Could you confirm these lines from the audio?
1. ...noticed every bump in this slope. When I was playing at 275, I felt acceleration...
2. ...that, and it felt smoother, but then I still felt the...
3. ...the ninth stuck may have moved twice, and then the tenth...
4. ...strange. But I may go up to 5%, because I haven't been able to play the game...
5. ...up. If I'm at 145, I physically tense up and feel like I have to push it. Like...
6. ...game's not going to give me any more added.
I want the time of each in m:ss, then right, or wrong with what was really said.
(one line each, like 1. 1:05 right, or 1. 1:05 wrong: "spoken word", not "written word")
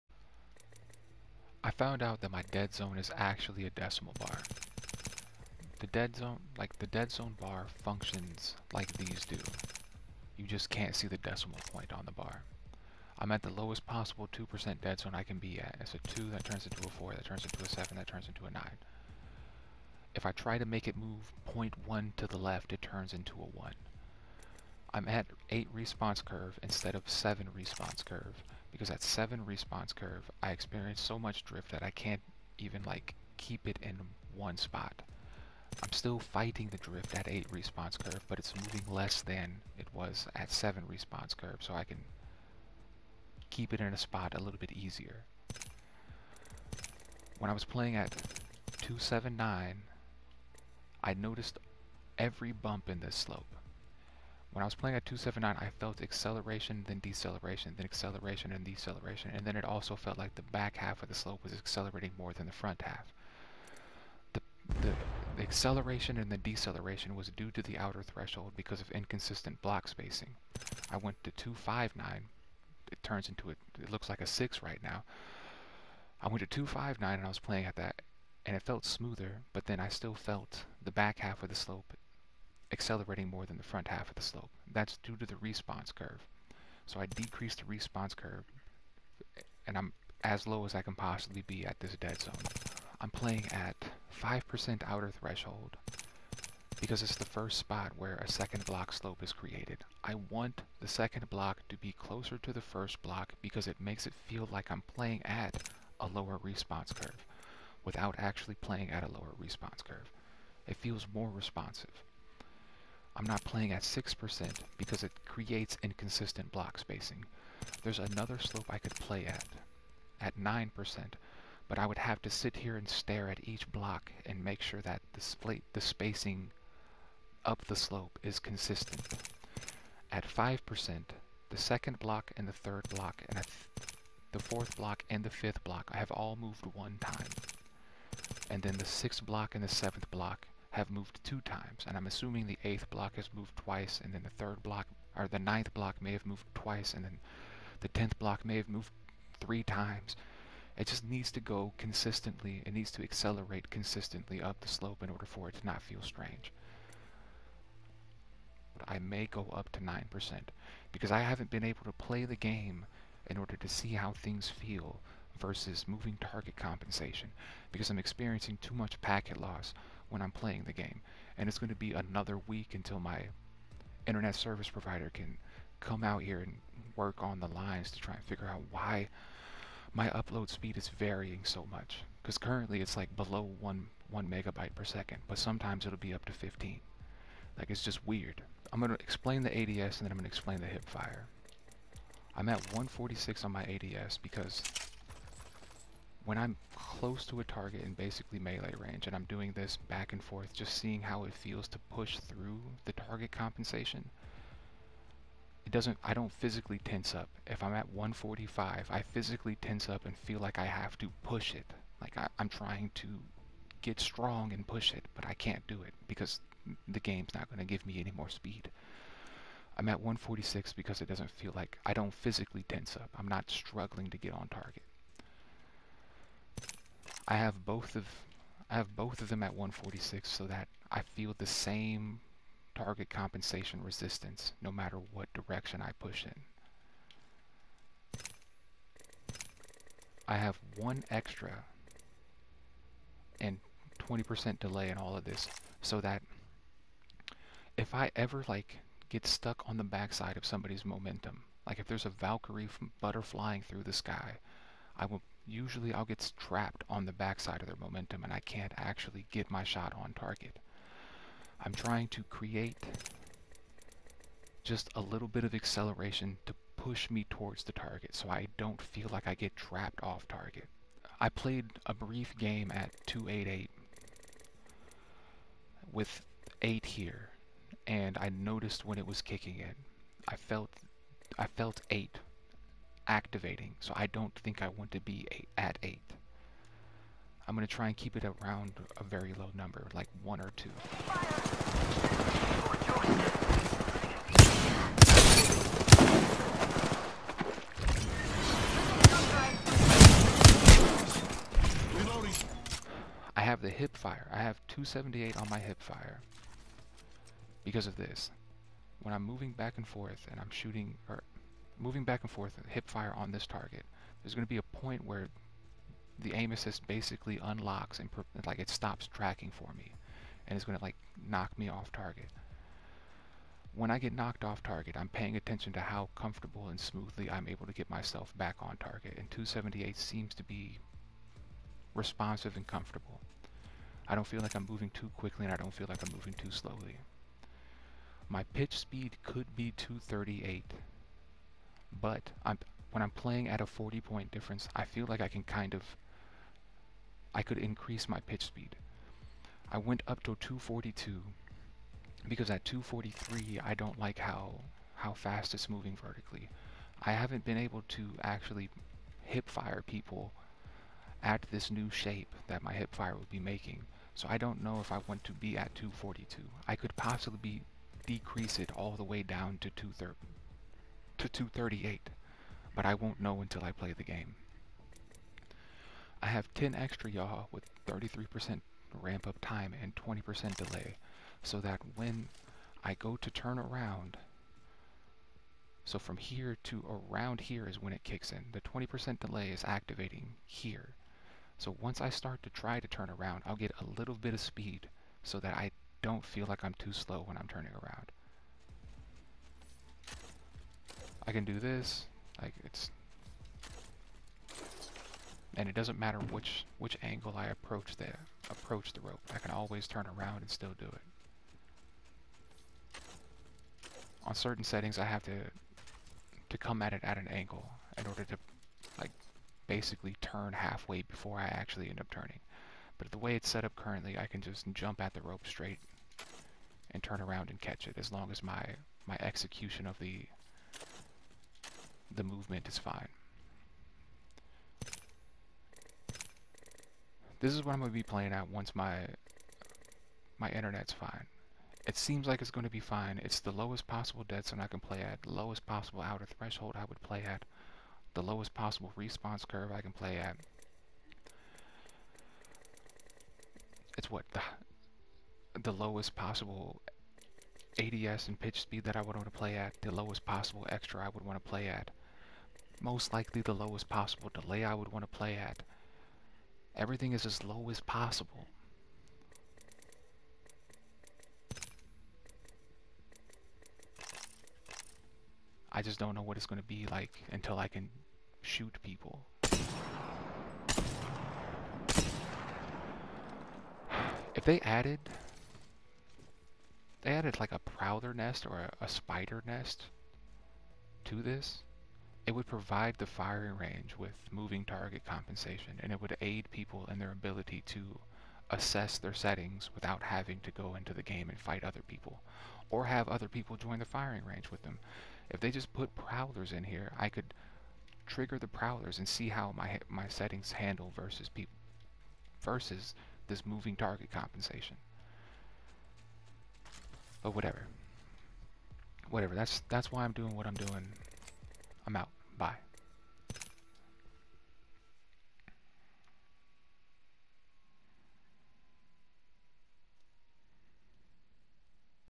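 1. 0:51 wrong: "279", not "275"
2. 1:17 right
3. 2:25 wrong: "block", not "stuck"
4. 2:36 wrong: "9", not "5"
5. 3:27 right
6. 3:36 wrong: "speed", not "added".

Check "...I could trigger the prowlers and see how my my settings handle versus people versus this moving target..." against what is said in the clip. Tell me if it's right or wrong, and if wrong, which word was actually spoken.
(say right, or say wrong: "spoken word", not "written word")
right.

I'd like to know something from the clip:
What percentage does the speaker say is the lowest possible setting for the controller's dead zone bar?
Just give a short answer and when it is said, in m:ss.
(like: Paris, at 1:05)
2%, at 0:14.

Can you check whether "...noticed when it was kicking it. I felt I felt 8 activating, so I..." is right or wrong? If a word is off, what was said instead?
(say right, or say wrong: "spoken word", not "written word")
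right.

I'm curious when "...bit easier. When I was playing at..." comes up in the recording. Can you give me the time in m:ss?
0:44.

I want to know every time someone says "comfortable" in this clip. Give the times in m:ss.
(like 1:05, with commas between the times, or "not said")
5:26, 5:32.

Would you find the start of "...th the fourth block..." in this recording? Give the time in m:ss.
2:13.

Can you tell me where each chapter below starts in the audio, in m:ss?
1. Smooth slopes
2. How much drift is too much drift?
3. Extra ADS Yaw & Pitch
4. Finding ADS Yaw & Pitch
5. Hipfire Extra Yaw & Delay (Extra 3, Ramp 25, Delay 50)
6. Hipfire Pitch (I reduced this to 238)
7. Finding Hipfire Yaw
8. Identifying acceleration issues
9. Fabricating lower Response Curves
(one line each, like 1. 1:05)
1. 2:10
2. 0:25
3. 3:58
4. 3:09
5. 6:15
6. 5:37
7. 5:03
8. 0:45
9. 1:33.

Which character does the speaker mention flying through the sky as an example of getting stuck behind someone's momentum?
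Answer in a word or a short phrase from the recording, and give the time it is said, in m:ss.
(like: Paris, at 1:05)
Valkyrie, at 4:12.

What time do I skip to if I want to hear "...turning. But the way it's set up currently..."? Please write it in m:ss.
7:02.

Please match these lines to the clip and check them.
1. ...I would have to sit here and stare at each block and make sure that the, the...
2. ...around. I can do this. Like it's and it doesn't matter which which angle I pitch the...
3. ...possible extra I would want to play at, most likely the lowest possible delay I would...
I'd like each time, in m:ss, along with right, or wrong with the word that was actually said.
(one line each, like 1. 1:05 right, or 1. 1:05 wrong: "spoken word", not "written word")
1. 2:01 right
2. 6:37 wrong: "approach", not "pitch"
3. 7:40 right.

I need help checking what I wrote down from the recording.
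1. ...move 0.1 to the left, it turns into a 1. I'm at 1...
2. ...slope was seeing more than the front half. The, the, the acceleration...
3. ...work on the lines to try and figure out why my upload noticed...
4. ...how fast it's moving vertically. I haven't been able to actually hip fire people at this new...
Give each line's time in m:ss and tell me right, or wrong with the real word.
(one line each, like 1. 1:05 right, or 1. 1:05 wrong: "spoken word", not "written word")
1. 0:20 wrong: "8", not "1"
2. 1:01 wrong: "accelerating", not "seeing"
3. 2:56 wrong: "speed", not "noticed"
4. 5:54 right.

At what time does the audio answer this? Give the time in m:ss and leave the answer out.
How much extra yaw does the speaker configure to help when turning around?
6:16.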